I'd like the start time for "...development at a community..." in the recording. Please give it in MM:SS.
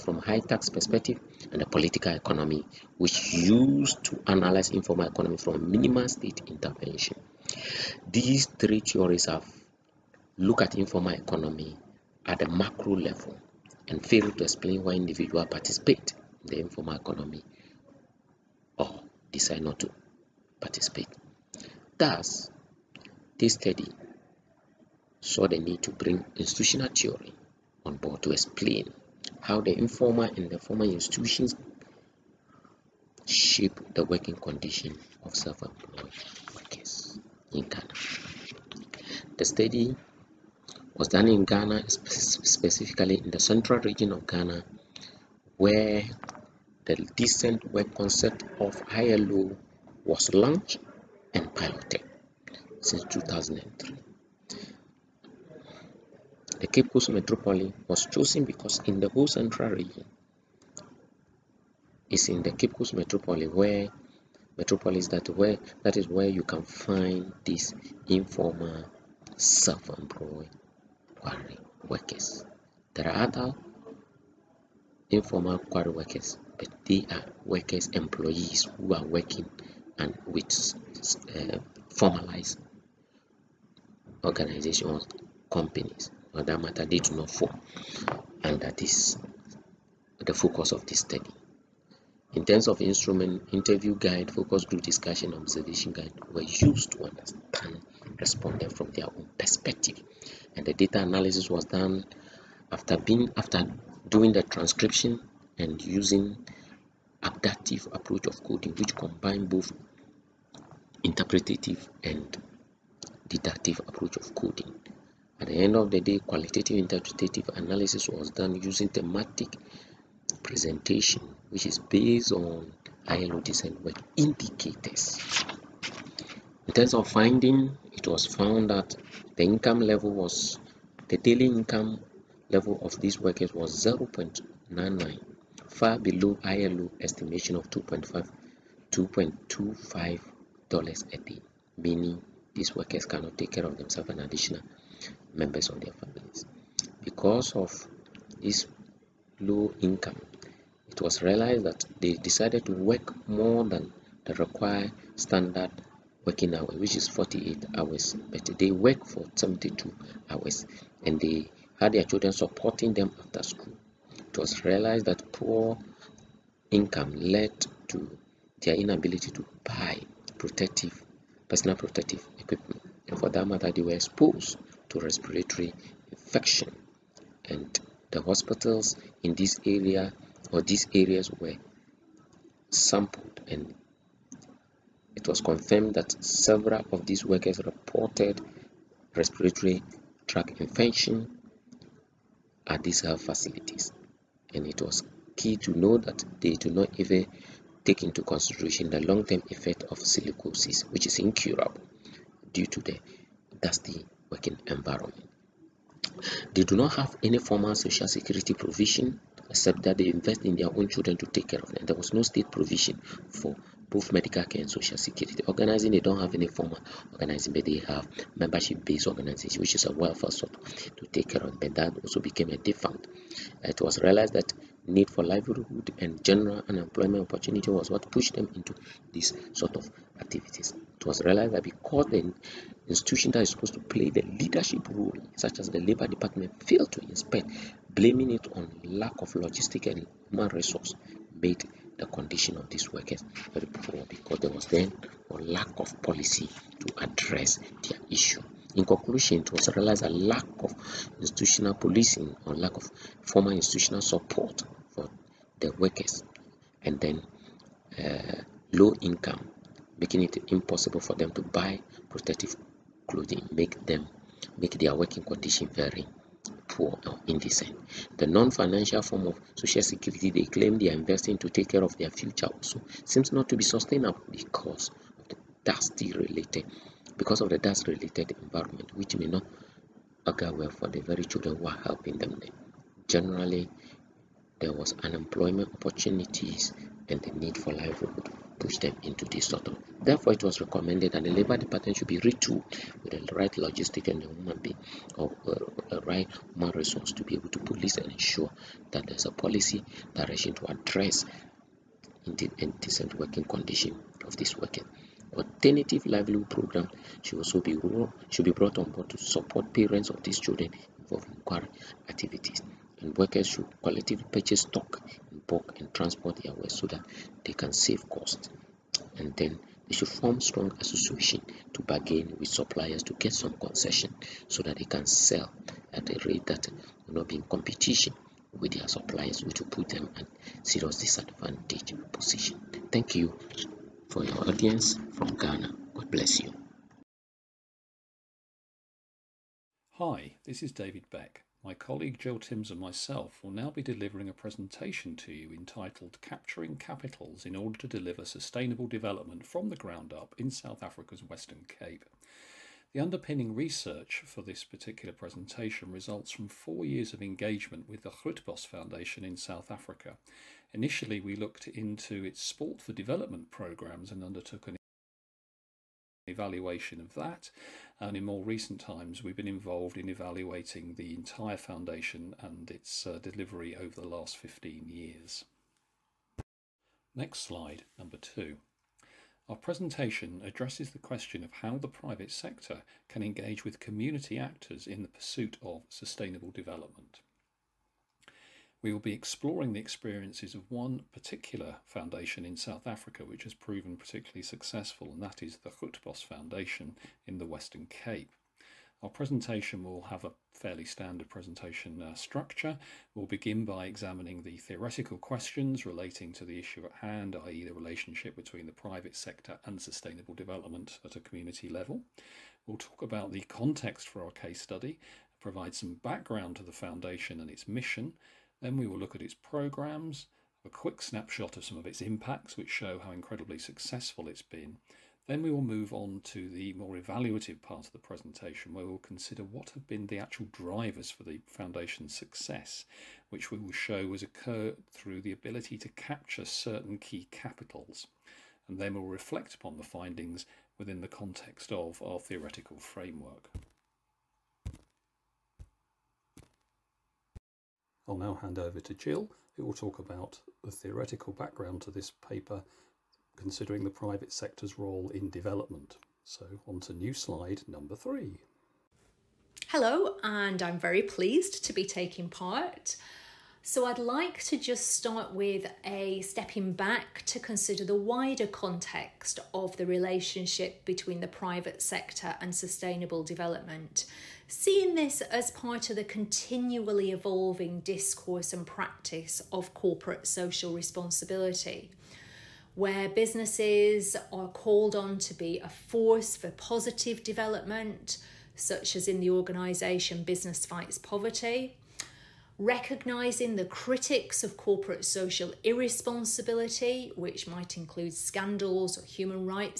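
06:50.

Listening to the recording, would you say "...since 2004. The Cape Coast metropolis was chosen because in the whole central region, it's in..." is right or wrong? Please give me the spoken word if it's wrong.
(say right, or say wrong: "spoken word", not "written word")
wrong: "2003", not "2004".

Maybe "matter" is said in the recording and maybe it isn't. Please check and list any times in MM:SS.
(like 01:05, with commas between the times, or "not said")
01:26, 02:53.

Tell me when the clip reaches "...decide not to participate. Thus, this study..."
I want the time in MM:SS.
00:19.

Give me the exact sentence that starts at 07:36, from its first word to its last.
So on to new slide number three.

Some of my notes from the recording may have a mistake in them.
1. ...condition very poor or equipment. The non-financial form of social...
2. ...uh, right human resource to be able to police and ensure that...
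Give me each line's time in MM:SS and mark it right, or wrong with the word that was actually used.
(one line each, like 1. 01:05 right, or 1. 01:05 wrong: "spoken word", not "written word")
1. 04:25 wrong: "indecent", not "equipment"
2. 04:55 right.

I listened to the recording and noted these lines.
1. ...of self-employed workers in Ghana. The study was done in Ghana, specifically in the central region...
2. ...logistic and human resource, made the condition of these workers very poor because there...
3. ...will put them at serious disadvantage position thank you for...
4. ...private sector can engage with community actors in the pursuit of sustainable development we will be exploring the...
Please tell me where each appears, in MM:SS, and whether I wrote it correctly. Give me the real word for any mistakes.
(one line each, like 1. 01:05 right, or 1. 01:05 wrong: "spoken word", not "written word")
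1. 00:35 right
2. 03:59 right
3. 05:29 right
4. 06:21 right.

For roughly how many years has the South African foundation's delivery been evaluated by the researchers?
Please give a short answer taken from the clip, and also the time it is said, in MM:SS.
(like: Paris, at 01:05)
15, at 06:14.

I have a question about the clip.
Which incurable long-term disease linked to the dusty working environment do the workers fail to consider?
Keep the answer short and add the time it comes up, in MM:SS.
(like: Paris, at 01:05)
silicosis, at 03:19.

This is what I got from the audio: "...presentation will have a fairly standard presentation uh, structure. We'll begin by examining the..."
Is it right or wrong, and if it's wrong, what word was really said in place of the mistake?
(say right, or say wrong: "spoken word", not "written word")
right.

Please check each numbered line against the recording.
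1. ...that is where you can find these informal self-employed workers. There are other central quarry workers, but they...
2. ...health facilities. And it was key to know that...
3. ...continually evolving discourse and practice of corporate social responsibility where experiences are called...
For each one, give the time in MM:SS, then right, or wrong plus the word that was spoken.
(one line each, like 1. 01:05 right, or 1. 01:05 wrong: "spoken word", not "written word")
1. 01:05 wrong: "informal", not "central"
2. 03:13 right
3. 07:56 wrong: "businesses", not "experiences".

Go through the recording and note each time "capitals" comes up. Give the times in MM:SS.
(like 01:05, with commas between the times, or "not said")
05:46, 07:17.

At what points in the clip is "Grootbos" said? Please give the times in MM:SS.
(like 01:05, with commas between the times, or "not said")
05:58, 06:35.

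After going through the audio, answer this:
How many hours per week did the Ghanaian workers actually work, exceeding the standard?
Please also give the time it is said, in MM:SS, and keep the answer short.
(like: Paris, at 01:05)
72, at 02:39.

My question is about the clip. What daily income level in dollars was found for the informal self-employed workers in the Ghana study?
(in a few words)
0.99.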